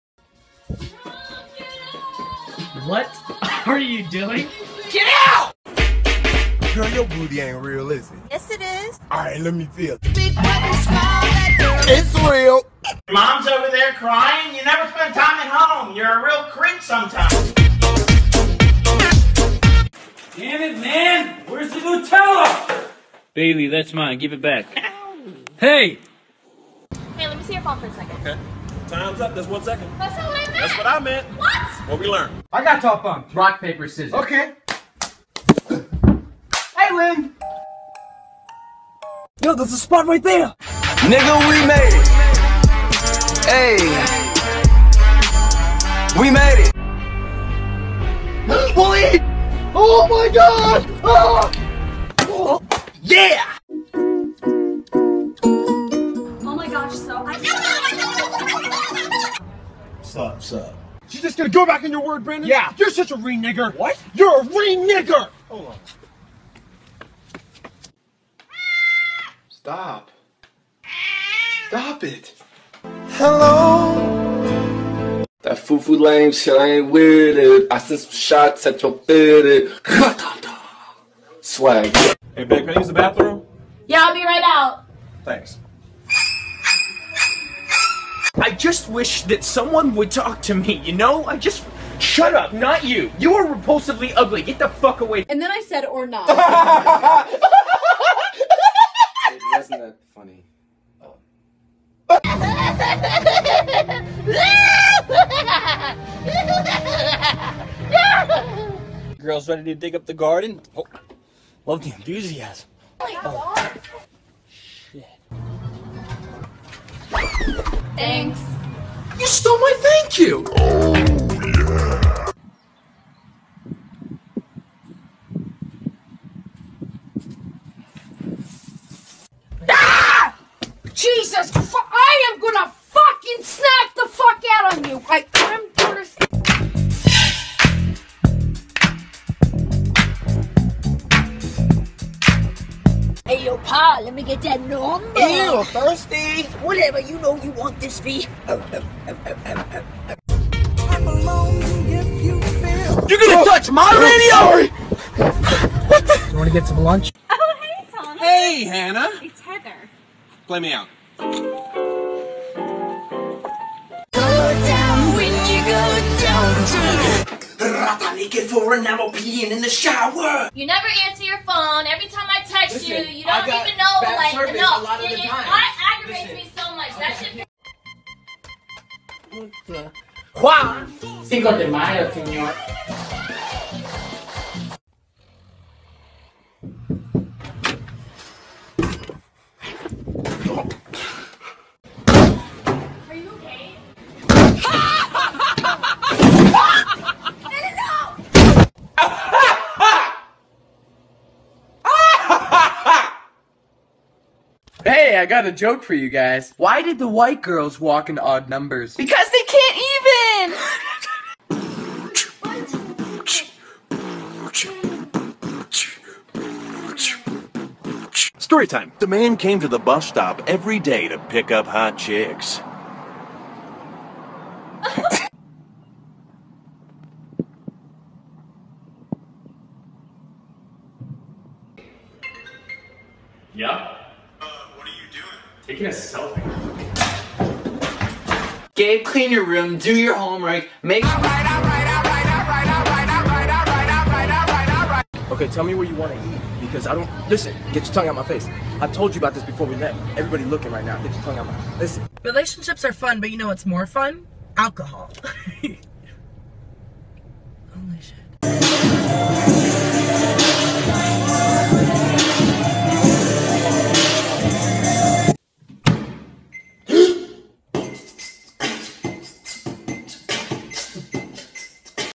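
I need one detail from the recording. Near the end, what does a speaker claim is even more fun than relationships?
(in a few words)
Alcohol.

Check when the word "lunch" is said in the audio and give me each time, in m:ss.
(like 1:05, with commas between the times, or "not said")
2:36.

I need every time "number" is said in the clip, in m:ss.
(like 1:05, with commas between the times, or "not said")
2:24, 3:28.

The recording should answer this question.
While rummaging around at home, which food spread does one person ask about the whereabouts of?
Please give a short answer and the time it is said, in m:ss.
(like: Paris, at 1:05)
Nutella, at 0:21.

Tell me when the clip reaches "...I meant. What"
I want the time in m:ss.
0:30.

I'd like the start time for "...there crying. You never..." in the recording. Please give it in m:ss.
0:13.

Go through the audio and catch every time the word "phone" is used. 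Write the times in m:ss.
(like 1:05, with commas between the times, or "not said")
0:27, 2:51.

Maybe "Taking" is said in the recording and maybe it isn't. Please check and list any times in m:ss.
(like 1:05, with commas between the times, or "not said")
3:55.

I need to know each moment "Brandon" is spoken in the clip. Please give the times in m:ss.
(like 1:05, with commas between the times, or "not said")
1:02.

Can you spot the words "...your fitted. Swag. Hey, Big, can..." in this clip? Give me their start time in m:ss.
1:18.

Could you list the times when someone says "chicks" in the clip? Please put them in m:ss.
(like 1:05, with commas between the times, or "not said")
3:41.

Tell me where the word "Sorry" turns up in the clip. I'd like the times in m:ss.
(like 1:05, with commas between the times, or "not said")
2:34.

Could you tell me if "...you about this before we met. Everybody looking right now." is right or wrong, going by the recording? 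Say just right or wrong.
right.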